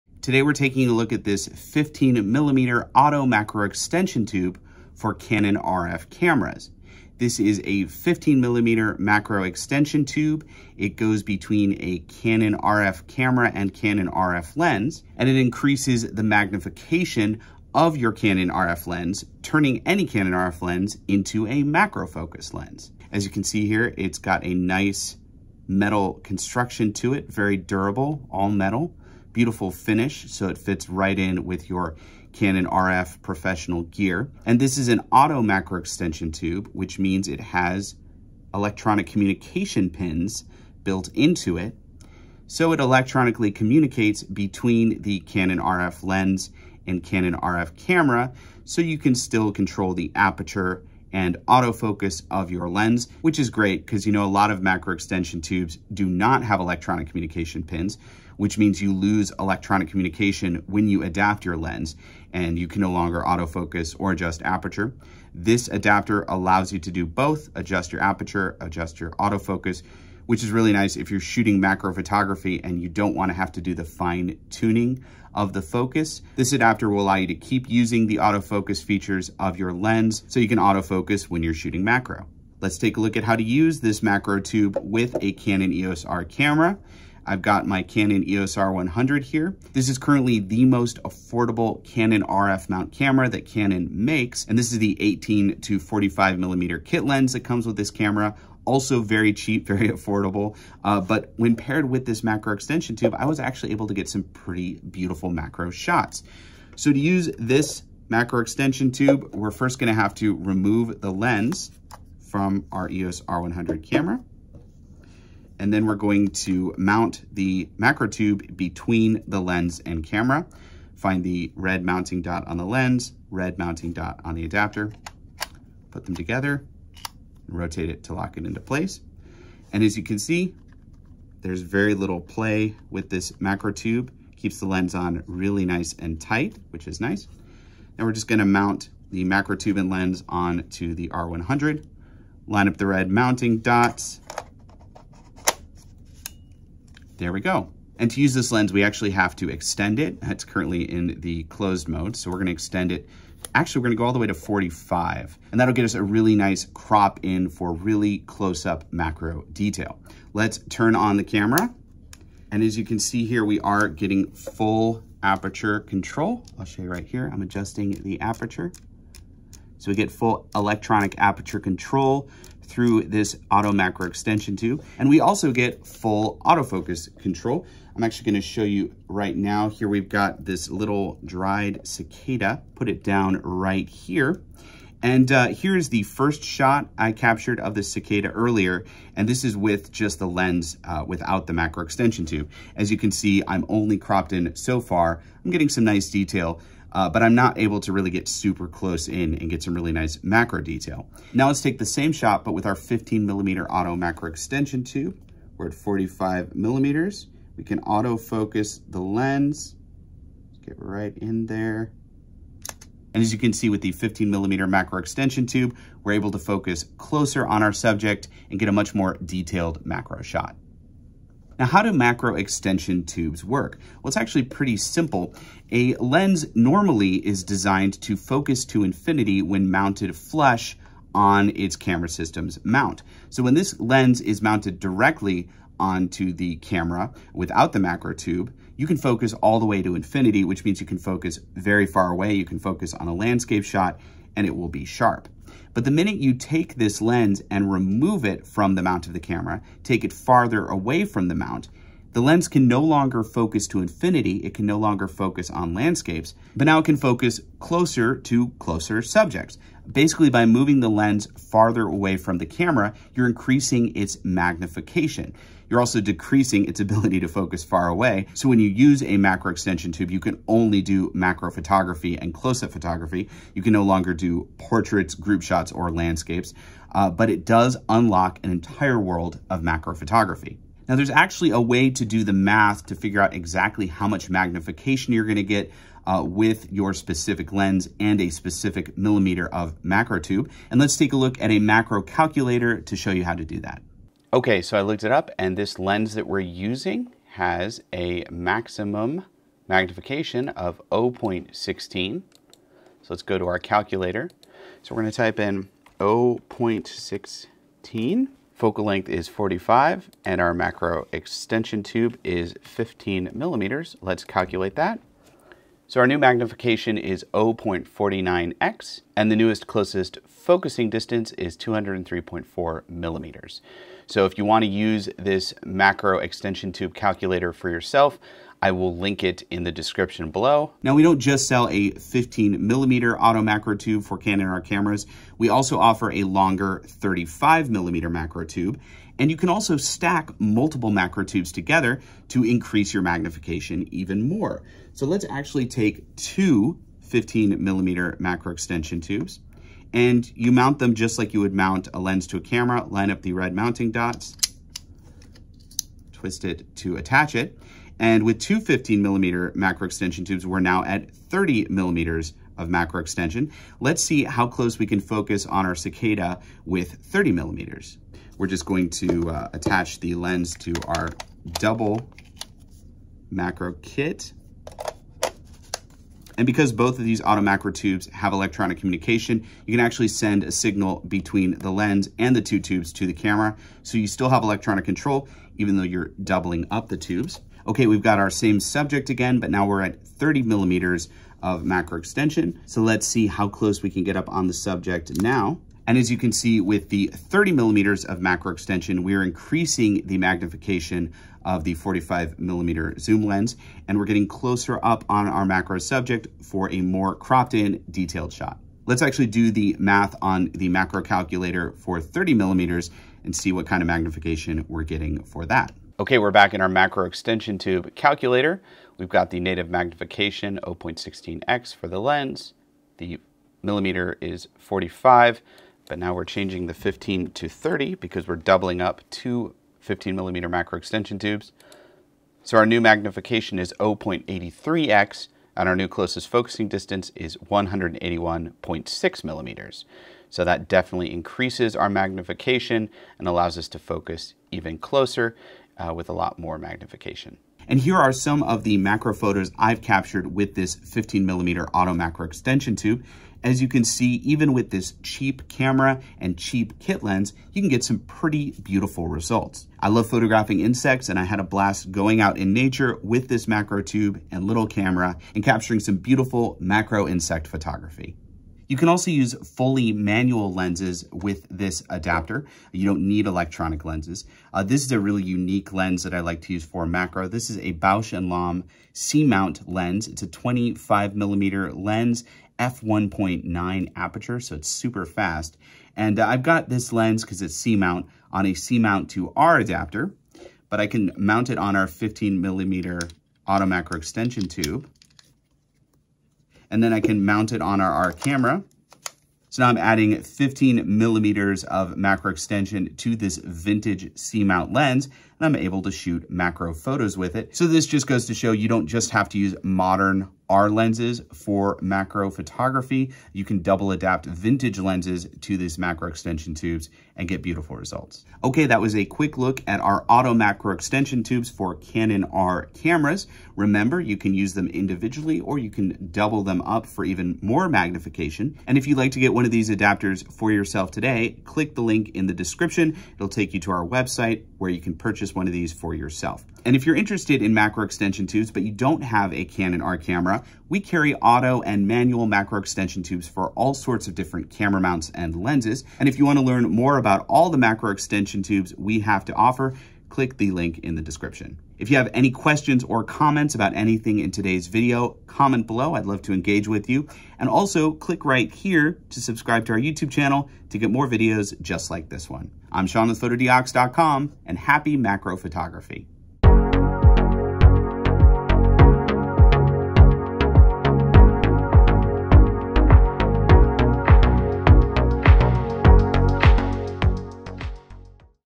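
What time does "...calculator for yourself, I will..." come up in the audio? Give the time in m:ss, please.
5:26.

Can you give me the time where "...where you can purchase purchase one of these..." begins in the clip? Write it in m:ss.
8:54.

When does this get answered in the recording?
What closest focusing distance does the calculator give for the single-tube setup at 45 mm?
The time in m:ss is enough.
5:21.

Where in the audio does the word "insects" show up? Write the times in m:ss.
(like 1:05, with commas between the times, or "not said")
7:40, 7:47.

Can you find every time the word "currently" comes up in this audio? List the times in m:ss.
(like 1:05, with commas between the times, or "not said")
1:29, 2:30.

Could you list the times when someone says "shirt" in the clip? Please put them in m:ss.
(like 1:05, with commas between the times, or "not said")
not said.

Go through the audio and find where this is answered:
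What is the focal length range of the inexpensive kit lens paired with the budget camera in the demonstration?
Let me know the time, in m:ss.
1:34.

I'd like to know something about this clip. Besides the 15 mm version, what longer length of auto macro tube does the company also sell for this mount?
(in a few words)
35 mm.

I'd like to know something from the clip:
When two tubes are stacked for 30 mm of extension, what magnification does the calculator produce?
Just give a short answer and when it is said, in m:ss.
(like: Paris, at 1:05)
0.83x, at 7:13.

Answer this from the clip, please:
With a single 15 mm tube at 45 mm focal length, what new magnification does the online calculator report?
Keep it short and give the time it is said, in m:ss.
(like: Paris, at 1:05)
0.49x, at 5:17.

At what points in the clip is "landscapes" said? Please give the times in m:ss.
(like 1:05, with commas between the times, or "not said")
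4:03, 4:15, 4:35.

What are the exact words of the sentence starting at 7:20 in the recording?
So that definitely increases our magnification and allows us to focus even closer uh, with a lot more magnification.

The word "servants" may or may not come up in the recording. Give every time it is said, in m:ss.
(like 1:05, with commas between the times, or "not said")
not said.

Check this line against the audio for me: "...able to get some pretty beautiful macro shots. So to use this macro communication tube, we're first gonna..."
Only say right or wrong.
wrong.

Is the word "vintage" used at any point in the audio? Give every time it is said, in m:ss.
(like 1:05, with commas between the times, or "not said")
8:23, 8:34.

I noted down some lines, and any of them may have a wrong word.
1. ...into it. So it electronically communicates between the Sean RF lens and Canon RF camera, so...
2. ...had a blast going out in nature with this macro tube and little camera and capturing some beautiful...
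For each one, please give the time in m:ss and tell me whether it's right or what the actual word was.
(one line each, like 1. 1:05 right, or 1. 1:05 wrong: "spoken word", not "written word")
1. 0:41 wrong: "Canon", not "Sean"
2. 7:41 right.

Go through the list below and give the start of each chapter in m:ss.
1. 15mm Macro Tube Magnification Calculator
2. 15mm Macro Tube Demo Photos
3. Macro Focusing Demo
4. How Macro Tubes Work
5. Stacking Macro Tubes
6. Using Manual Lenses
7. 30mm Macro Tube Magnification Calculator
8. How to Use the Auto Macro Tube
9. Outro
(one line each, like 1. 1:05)
1. 4:40
2. 7:27
3. 2:54
4. 3:41
5. 5:30
6. 7:48
7. 6:48
8. 1:22
9. 8:38.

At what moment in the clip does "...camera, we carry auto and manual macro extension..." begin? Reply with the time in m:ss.
8:59.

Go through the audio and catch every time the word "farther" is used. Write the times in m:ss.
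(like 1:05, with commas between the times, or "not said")
4:10, 4:21.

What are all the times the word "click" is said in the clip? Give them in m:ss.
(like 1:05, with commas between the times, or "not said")
8:51, 9:10, 9:17.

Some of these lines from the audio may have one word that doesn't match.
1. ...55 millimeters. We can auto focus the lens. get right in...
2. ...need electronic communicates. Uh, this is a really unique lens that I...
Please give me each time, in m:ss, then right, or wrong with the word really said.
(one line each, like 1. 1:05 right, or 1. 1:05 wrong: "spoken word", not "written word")
1. 3:25 wrong: "45", not "55"
2. 7:53 wrong: "lenses", not "communicates".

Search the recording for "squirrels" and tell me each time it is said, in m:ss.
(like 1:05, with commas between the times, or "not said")
not said.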